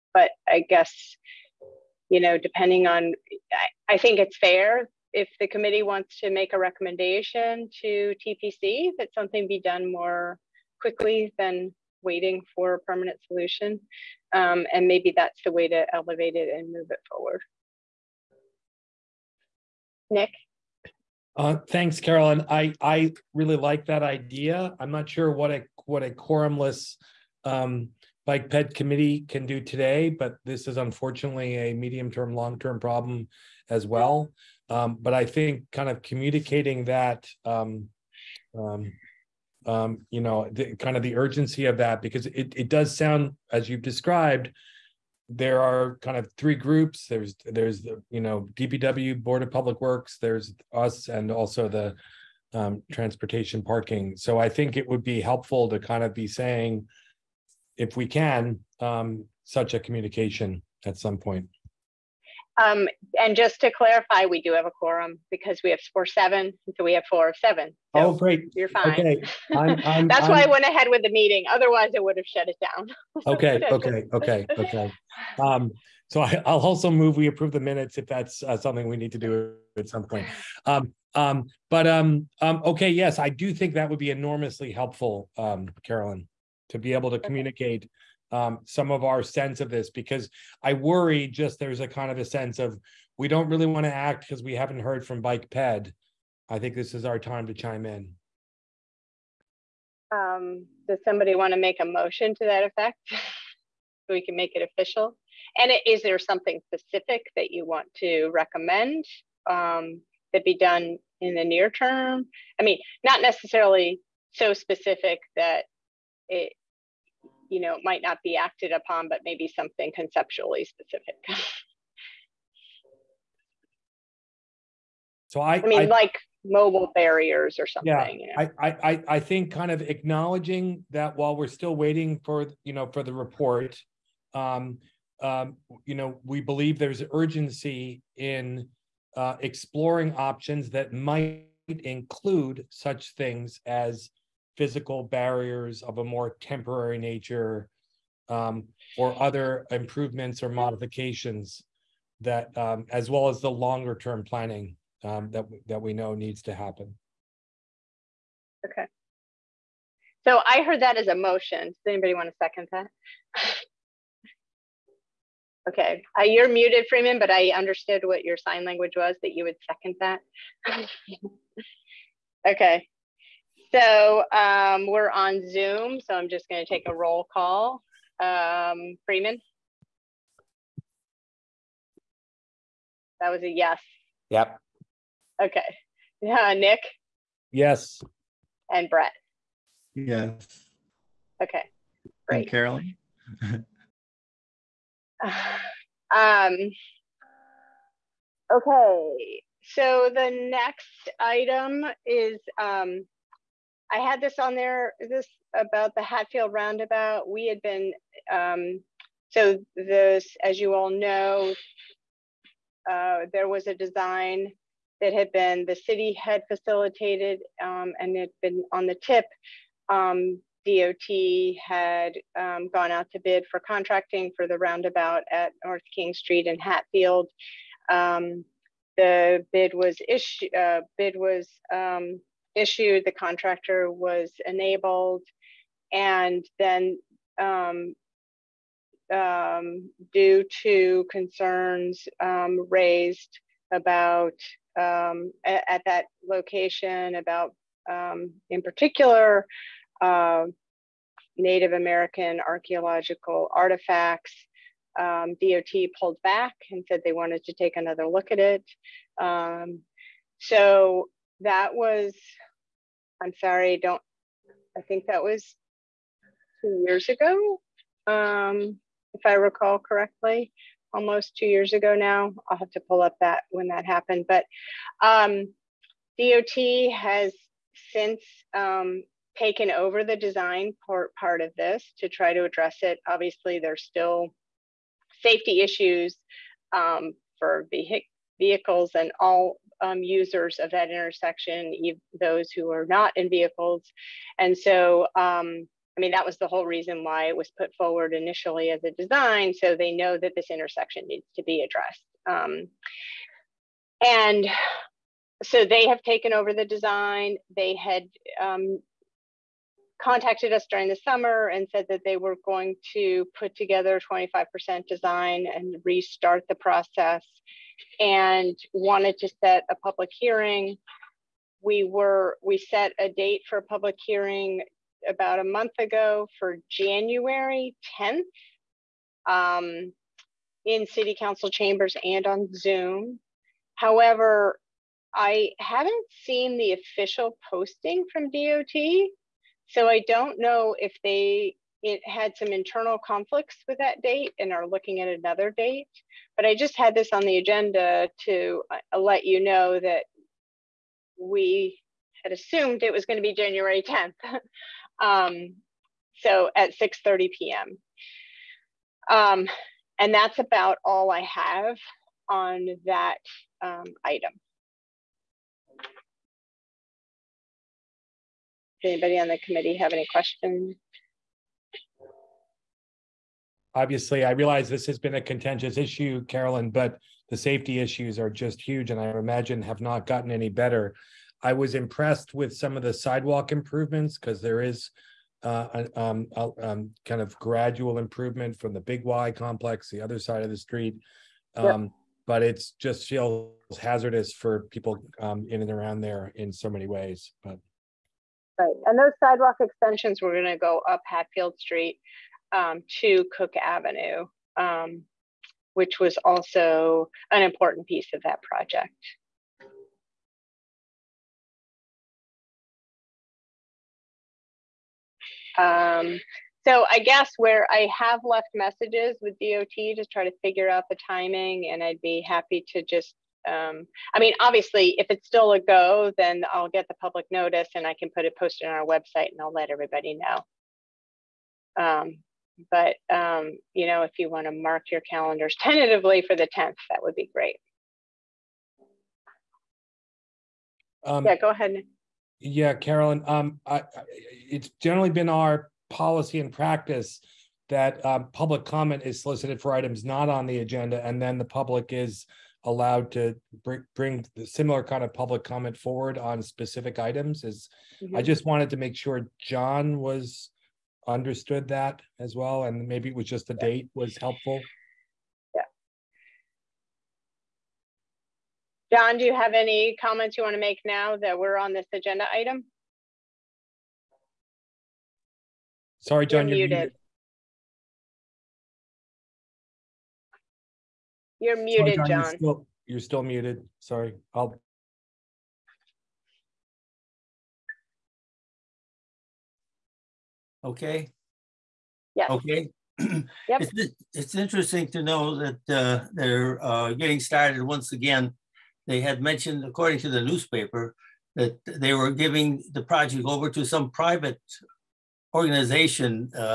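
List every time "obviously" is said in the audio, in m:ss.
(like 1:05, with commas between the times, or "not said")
4:43, 6:13, 7:04.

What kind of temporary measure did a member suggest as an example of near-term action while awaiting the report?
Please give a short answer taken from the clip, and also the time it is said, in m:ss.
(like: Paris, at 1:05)
mobile barriers, at 2:06.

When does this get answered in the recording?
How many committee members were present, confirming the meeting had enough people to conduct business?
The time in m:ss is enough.
1:07.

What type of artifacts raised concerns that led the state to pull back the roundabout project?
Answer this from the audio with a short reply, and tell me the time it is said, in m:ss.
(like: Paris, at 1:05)
Native American archaeological artifacts, at 4:11.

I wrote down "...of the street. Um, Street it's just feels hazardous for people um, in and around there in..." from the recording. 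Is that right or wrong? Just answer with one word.
wrong.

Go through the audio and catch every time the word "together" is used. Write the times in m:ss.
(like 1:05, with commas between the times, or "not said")
5:13.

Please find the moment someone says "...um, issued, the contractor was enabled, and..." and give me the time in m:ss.
3:51.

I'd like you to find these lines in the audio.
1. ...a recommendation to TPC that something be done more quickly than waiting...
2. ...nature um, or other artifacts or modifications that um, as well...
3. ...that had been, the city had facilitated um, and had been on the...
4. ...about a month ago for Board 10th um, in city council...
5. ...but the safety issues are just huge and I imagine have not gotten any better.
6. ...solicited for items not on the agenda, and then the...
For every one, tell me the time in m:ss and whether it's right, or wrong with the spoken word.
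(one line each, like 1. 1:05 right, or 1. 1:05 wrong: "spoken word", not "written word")
1. 0:06 right
2. 2:26 wrong: "improvements", not "artifacts"
3. 3:35 right
4. 5:25 wrong: "January", not "Board"
5. 6:16 right
6. 7:29 right.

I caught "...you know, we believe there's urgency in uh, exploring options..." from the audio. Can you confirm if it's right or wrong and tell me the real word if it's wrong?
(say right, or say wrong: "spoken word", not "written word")
right.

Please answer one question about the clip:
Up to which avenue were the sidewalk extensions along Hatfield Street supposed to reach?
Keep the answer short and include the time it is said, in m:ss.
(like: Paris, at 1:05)
Cook Avenue, at 6:43.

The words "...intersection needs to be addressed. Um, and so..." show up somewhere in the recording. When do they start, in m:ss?
5:00.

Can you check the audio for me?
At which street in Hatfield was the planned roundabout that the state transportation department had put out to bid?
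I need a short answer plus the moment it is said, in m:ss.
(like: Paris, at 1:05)
North King Street, at 3:45.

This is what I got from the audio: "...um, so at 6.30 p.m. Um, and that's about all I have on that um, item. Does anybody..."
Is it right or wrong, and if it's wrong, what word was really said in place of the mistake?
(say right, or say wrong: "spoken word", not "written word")
right.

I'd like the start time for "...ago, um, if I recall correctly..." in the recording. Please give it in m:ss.
4:27.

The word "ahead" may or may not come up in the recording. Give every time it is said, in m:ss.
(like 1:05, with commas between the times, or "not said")
1:10, 7:21.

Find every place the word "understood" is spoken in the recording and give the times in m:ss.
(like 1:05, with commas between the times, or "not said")
2:47, 7:41.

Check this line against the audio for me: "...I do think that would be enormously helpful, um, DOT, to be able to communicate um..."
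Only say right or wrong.
wrong.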